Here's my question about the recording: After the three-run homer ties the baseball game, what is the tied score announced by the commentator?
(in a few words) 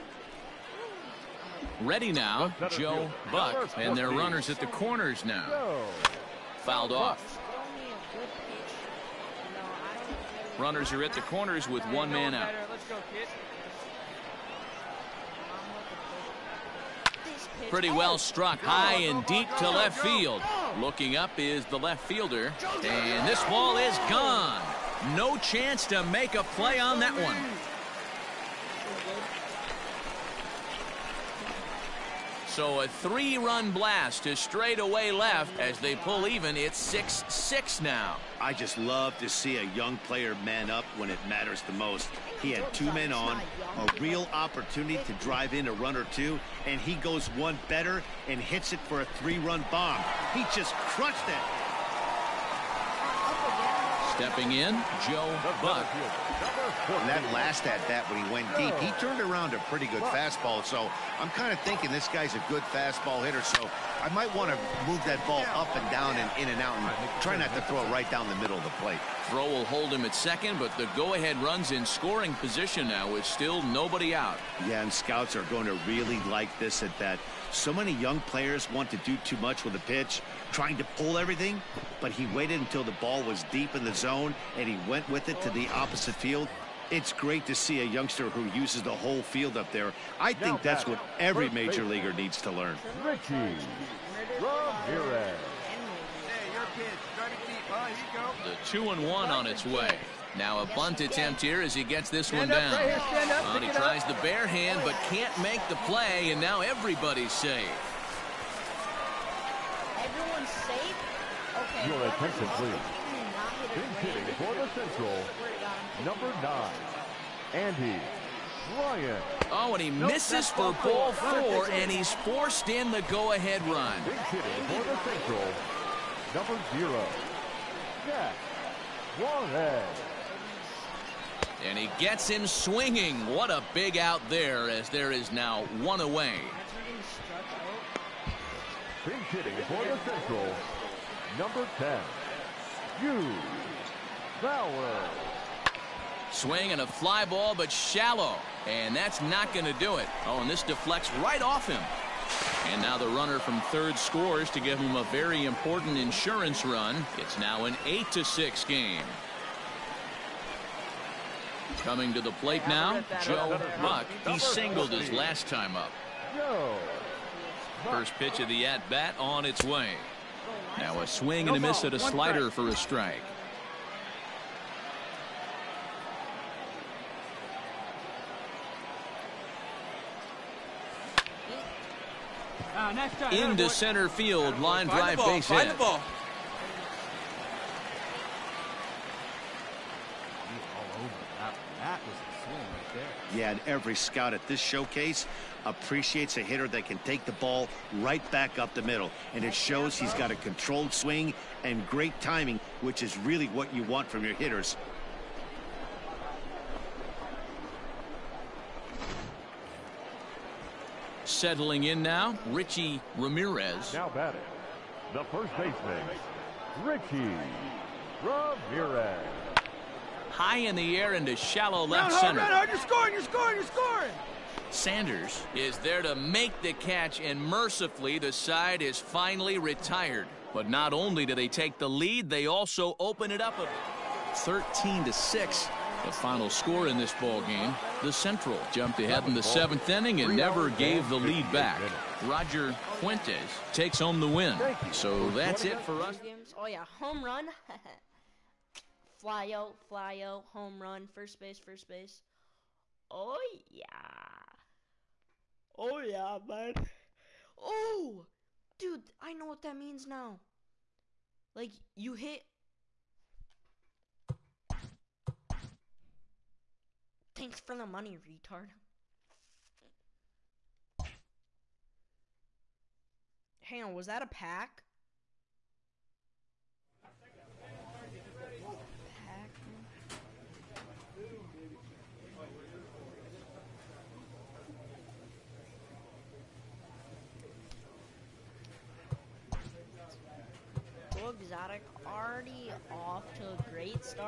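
6-6.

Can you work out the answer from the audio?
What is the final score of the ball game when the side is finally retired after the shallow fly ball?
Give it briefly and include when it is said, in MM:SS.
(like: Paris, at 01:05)
13 to 6, at 03:54.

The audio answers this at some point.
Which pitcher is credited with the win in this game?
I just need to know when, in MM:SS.
04:02.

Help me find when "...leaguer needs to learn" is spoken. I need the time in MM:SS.
01:31.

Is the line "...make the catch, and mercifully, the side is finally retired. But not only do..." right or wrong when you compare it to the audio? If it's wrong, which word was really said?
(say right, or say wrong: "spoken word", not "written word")
right.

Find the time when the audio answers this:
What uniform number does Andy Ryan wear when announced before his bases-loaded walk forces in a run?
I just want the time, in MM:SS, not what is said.
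01:56.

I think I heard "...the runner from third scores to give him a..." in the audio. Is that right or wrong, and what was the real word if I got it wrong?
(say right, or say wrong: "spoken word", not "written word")
right.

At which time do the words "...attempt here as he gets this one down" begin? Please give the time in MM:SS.
01:41.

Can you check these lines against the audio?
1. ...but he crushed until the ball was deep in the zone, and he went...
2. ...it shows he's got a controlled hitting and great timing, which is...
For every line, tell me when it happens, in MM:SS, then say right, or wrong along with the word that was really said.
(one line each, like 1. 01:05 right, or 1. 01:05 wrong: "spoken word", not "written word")
1. 01:21 wrong: "waited", not "crushed"
2. 03:19 wrong: "swing", not "hitting".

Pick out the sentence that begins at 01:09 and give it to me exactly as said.
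Throw will hold him at second, but the go-ahead runs in scoring position now with still nobody out.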